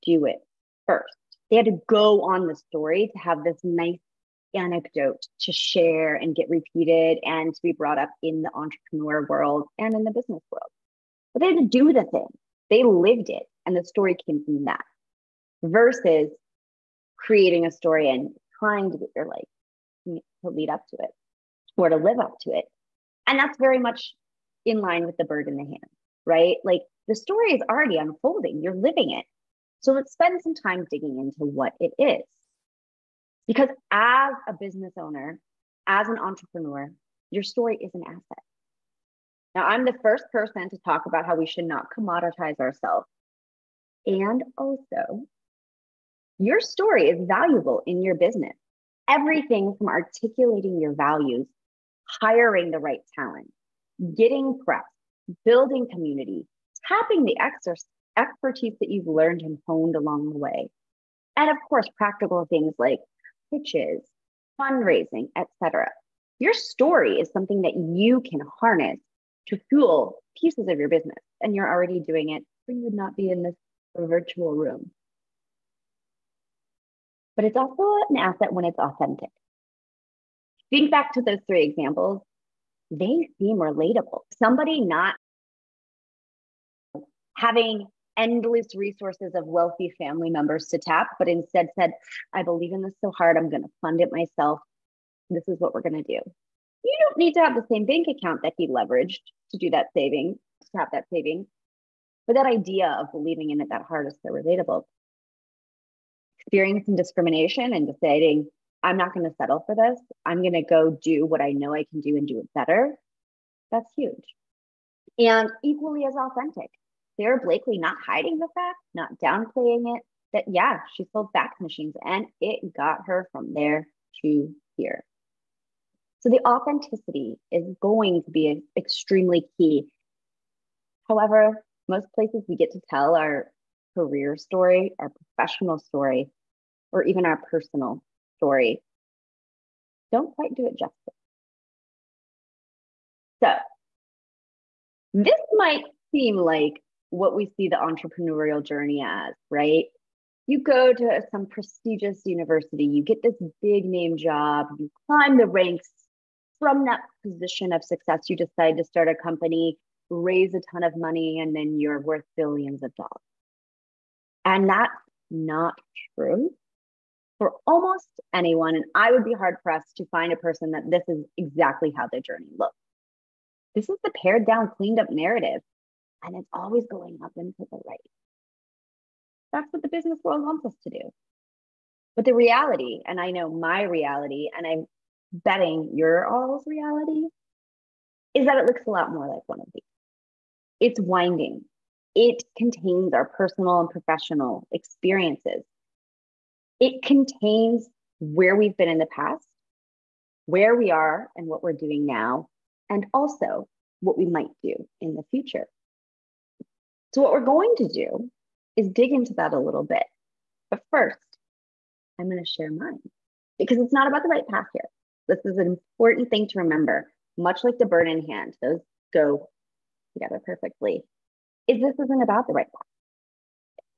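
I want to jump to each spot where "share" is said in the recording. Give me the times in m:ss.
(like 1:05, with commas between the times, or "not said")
0:05, 3:32.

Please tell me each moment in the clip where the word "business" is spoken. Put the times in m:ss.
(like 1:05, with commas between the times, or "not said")
0:10, 0:34, 0:48, 1:10, 2:59.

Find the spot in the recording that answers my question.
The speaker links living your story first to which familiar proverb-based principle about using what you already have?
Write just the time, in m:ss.
0:25.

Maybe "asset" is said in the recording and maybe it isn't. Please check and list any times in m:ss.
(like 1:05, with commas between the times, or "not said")
0:38, 1:18.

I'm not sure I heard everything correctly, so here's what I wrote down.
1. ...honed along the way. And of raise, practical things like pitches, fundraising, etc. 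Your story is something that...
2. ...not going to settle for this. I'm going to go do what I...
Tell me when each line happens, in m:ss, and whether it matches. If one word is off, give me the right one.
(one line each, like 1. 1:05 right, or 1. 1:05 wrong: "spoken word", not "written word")
1. 0:59 wrong: "course", not "raise"
2. 1:48 right.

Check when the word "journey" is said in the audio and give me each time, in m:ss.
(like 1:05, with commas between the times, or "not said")
2:28, 2:52.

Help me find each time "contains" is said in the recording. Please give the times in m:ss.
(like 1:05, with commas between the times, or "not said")
3:12, 3:17.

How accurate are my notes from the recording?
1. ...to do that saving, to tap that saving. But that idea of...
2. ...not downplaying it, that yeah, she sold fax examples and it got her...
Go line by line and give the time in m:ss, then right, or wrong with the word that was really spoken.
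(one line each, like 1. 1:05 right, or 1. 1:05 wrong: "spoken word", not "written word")
1. 1:39 right
2. 1:58 wrong: "machines", not "examples".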